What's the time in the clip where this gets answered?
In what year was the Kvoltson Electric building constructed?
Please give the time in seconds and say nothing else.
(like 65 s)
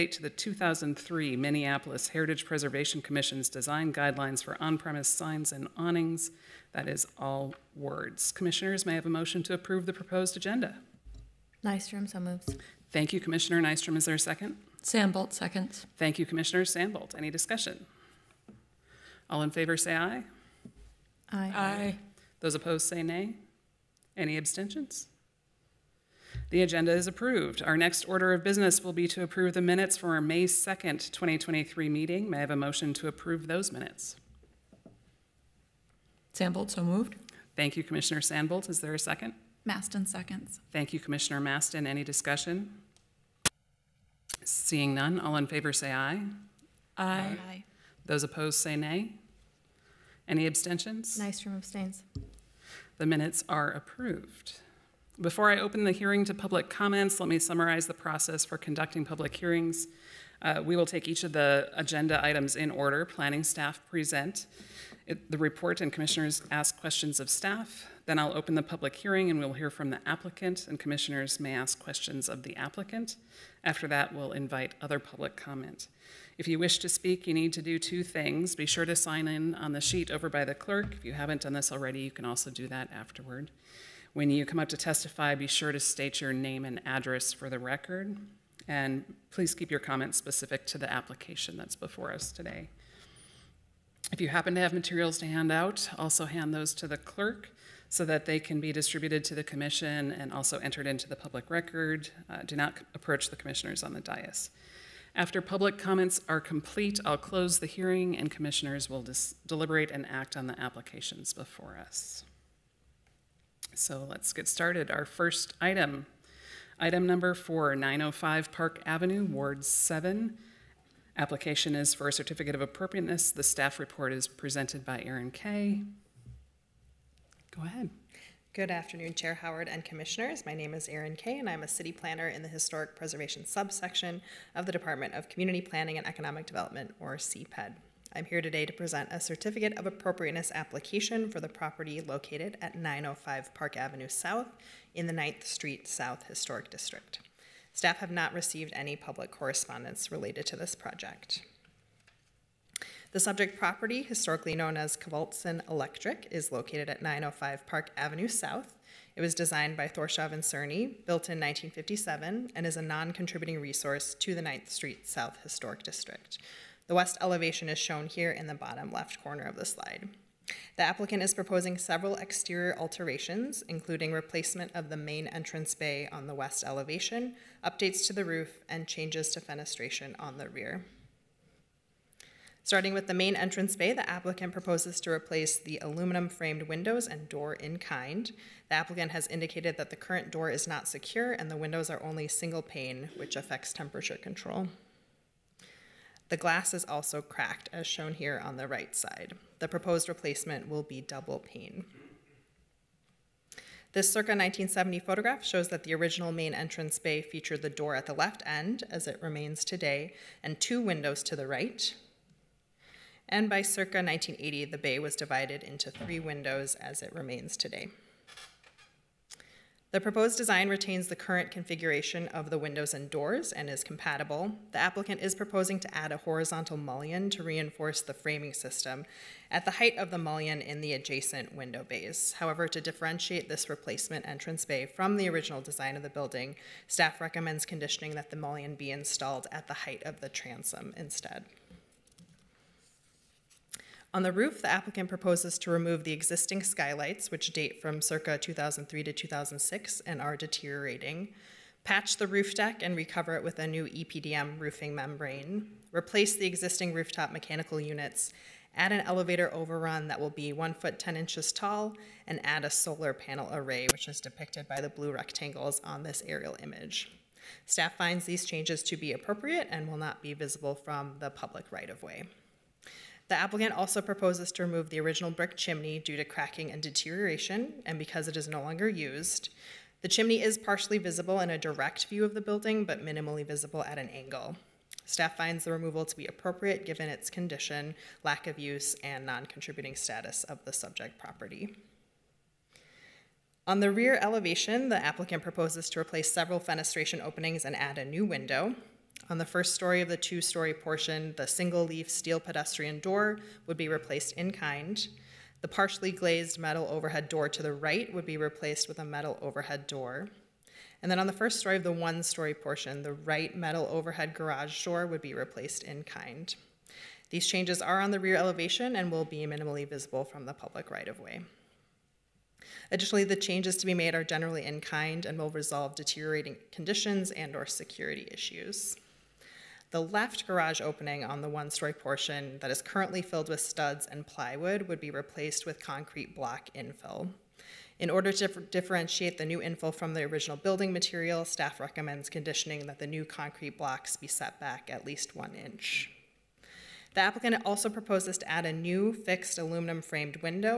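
161 s.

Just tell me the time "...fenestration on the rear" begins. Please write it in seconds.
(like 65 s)
179 s.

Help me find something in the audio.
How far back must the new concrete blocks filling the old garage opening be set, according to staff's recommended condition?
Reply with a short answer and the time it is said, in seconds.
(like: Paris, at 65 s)
at least 1 inch, at 344 s.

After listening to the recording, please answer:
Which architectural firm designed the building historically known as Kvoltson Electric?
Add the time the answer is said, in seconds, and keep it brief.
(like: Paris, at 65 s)
Thorshov and Cerny, at 159 s.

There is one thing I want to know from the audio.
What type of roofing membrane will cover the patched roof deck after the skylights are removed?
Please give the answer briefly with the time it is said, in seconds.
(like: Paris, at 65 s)
EPDM, at 253 s.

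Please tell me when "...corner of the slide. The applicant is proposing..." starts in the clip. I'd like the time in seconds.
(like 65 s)
169 s.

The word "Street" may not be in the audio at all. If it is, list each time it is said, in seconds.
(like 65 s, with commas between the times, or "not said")
145 s, 164 s.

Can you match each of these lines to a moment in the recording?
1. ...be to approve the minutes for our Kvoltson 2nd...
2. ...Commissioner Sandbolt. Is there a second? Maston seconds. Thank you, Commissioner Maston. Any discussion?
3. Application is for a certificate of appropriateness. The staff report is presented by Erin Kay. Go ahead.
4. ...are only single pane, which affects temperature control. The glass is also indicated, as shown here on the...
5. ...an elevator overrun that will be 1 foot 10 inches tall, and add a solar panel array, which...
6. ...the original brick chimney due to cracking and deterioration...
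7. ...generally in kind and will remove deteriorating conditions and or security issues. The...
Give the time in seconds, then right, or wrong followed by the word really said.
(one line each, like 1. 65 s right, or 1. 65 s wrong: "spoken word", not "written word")
1. 28 s wrong: "May", not "Kvoltson"
2. 37 s right
3. 121 s right
4. 191 s wrong: "cracked", not "indicated"
5. 258 s right
6. 274 s right
7. 324 s wrong: "resolve", not "remove".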